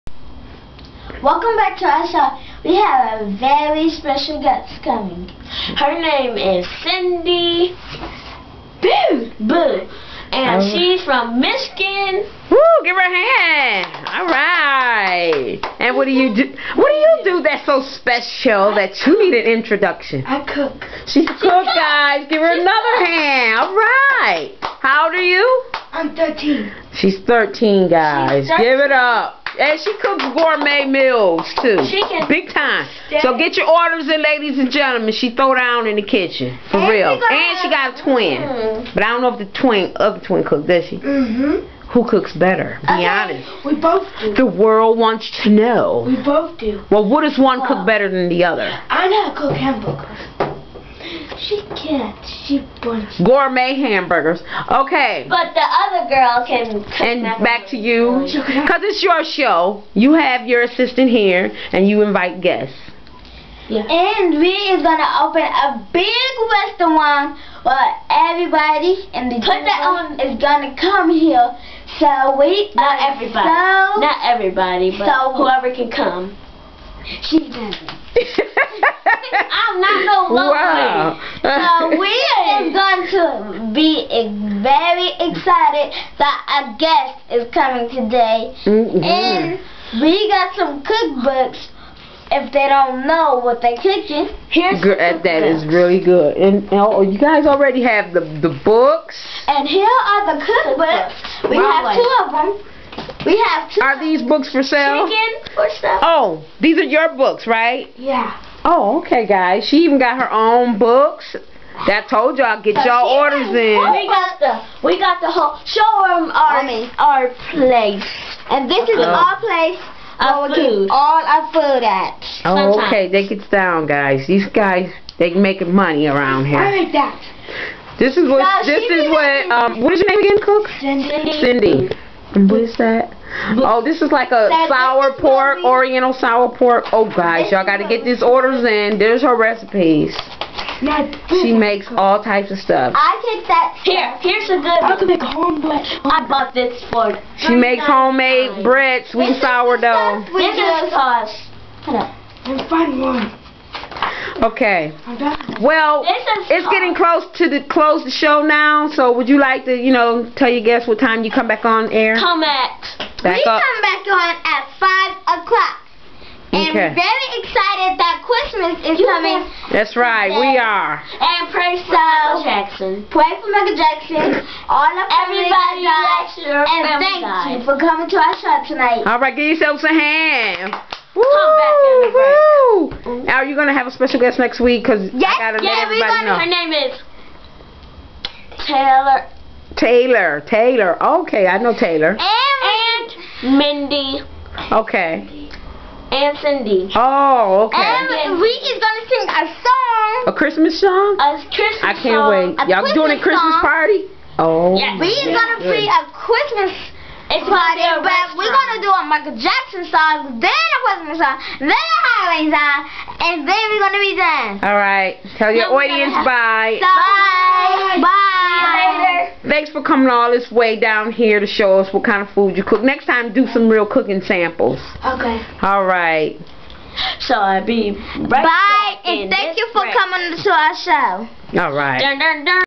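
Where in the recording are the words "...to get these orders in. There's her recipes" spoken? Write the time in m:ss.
2:17.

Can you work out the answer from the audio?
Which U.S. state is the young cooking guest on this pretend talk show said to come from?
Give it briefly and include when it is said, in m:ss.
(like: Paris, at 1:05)
Michigan, at 0:11.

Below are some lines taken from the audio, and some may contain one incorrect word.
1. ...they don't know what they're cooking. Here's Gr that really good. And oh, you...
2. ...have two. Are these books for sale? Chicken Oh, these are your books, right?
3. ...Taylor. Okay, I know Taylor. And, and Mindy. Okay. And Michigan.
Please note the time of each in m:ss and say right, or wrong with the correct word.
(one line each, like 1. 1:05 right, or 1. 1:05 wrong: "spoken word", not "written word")
1. 1:32 right
2. 1:43 right
3. 3:10 wrong: "Cindy", not "Michigan".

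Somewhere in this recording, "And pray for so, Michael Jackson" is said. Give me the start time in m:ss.
2:50.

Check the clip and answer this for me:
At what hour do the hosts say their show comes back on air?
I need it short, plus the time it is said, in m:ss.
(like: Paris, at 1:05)
5 o'clock, at 2:44.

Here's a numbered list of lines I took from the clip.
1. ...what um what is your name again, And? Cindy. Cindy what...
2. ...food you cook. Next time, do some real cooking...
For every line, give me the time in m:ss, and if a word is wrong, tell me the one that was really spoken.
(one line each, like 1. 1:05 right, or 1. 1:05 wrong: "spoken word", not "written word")
1. 2:09 wrong: "Cook", not "And"
2. 3:42 right.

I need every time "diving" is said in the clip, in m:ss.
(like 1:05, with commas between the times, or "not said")
not said.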